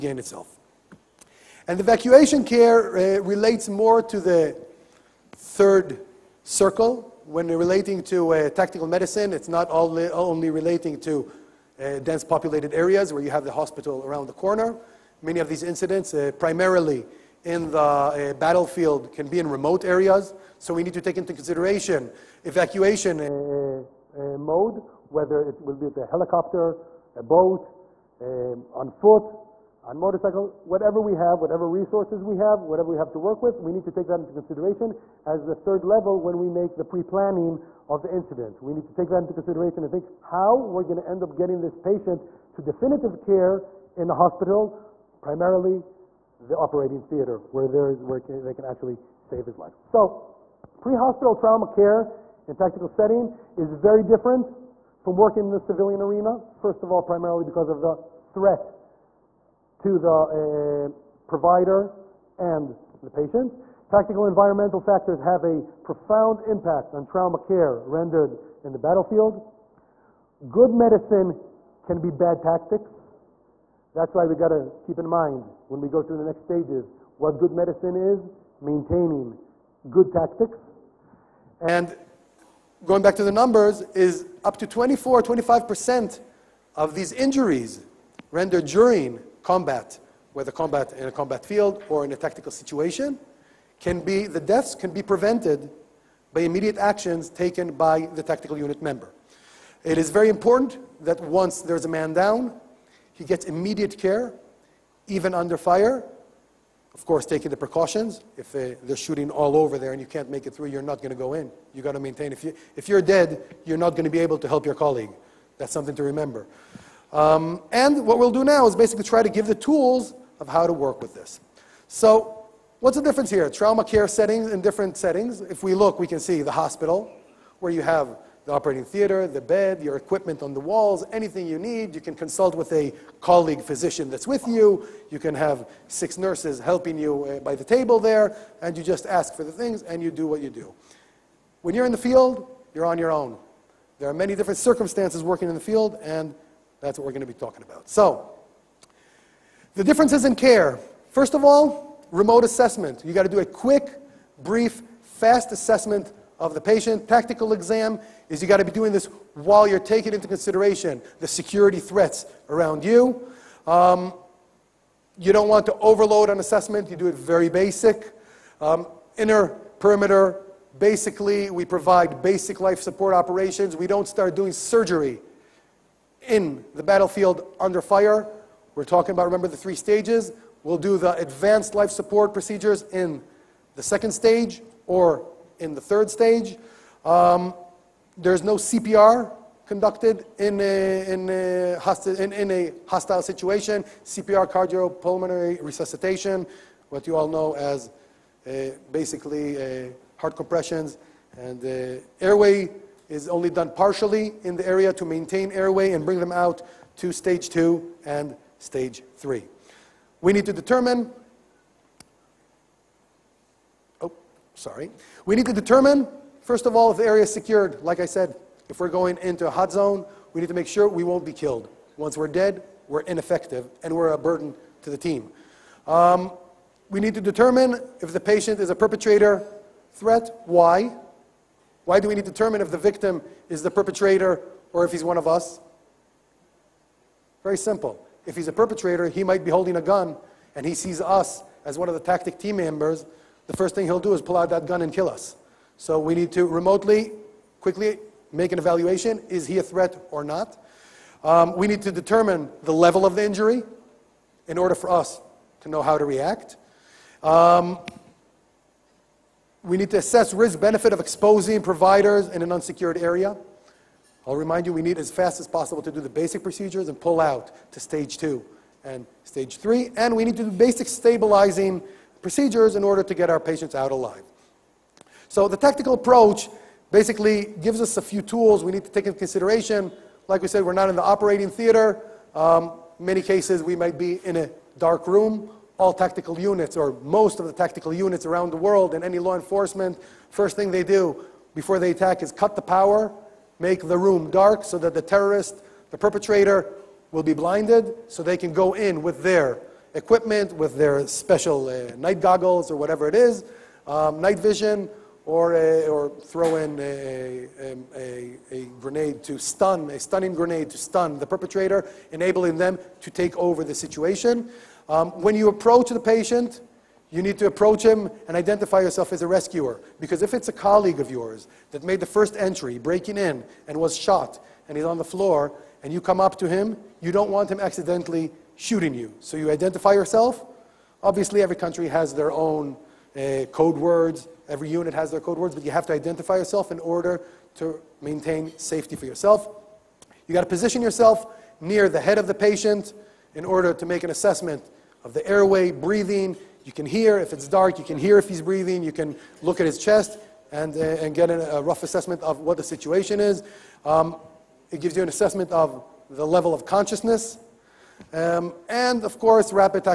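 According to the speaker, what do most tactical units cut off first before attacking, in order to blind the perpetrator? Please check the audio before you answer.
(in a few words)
The power.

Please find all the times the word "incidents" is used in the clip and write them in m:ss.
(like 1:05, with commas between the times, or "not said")
0:15, 0:38.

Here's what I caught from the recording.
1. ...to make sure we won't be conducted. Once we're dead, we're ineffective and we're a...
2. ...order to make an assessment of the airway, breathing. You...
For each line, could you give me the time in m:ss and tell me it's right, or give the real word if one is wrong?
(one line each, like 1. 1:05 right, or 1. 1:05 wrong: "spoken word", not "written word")
1. 3:40 wrong: "killed", not "conducted"
2. 5:43 right.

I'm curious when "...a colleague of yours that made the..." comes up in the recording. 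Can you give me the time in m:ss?
5:20.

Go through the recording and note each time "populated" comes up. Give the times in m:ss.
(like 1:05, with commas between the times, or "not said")
0:12.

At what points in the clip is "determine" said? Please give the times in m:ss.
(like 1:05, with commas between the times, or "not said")
3:30, 3:35, 3:47, 3:52, 4:11.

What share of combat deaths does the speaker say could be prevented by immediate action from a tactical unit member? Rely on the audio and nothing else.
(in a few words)
24-25%.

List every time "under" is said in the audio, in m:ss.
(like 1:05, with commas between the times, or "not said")
1:45, 2:57.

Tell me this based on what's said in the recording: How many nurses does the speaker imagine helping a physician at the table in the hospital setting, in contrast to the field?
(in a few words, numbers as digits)
6.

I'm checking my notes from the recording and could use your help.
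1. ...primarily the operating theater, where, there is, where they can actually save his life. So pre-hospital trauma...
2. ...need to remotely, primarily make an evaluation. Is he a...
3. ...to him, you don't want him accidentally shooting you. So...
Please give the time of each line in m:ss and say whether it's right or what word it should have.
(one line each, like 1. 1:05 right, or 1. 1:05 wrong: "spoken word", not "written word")
1. 0:45 right
2. 4:06 wrong: "quickly", not "primarily"
3. 5:26 right.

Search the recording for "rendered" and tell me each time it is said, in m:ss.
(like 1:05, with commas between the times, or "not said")
1:07, 1:28.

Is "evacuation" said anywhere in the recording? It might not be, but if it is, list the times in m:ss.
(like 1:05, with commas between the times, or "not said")
0:01, 0:22.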